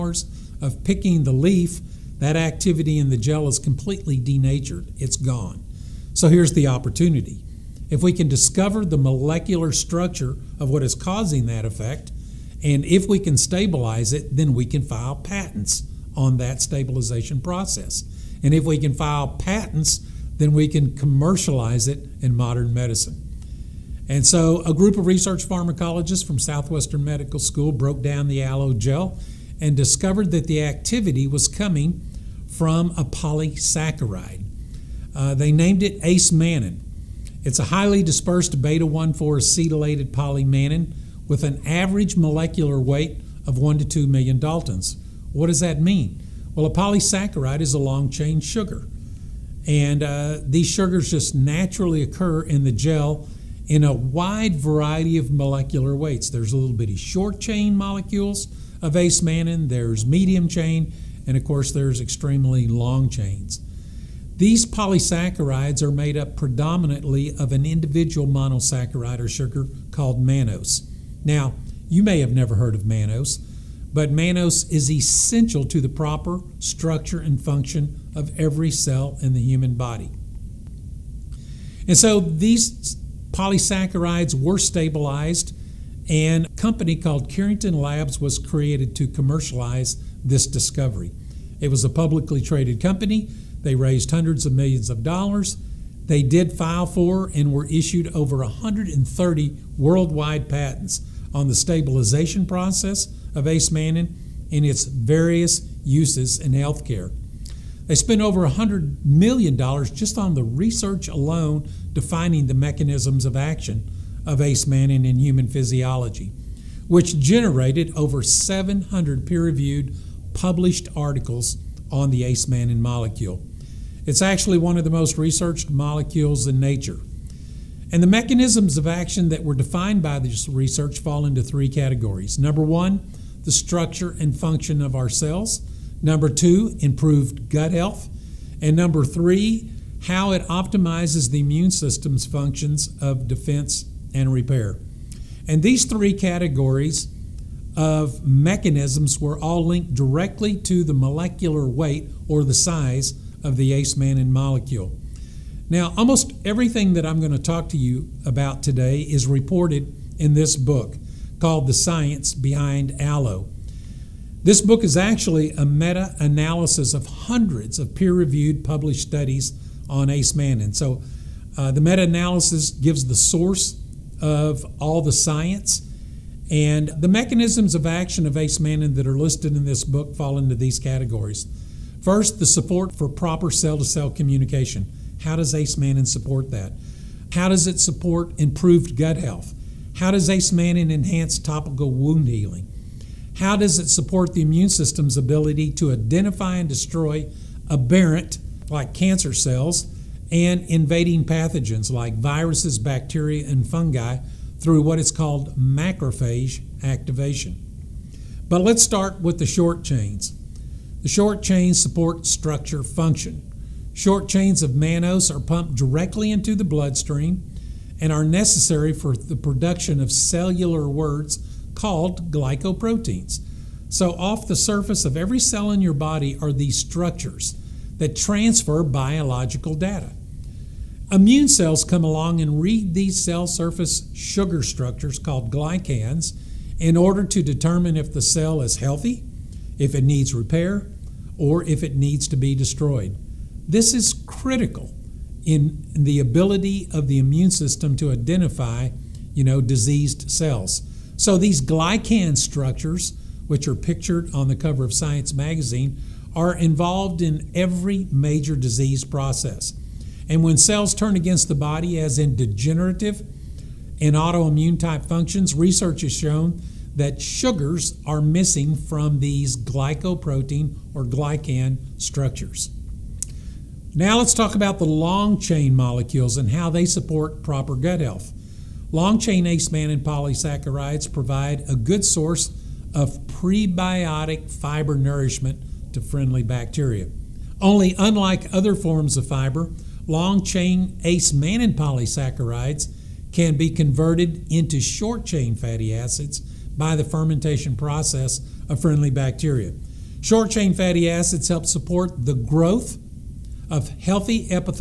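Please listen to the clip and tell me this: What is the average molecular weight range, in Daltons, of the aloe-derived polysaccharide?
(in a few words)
1 to 2 million Daltons.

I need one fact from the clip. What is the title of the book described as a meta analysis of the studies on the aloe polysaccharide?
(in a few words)
The Science Behind Aloe.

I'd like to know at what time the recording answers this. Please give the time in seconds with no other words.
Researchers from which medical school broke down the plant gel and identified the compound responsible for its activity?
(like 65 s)
26 s.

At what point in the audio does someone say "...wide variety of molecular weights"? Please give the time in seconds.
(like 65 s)
53 s.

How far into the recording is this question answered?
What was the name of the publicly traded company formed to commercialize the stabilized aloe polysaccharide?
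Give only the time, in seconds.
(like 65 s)
87 s.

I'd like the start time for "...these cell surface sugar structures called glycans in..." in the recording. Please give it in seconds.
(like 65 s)
232 s.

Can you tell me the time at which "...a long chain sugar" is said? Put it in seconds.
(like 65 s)
47 s.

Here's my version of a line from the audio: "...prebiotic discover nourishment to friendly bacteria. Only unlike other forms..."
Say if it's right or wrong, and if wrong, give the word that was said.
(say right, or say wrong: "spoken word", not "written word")
wrong: "fiber", not "discover".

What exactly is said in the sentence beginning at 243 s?
This is critical in the ability of the immune system to identify, you know, diseased cells.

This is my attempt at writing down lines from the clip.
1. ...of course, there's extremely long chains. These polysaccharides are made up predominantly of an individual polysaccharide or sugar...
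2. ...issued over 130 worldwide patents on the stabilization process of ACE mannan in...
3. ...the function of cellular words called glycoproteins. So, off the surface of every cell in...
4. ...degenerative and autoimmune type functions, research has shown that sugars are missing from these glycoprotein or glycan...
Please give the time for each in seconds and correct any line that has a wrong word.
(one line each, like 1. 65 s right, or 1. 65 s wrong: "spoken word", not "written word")
1. 61 s wrong: "monosaccharide", not "polysaccharide"
2. 97 s right
3. 219 s wrong: "production", not "function"
4. 262 s right.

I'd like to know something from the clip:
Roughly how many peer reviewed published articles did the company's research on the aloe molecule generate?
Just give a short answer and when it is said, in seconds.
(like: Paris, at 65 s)
over 700, at 117 s.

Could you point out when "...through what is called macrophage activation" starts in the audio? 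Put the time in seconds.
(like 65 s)
204 s.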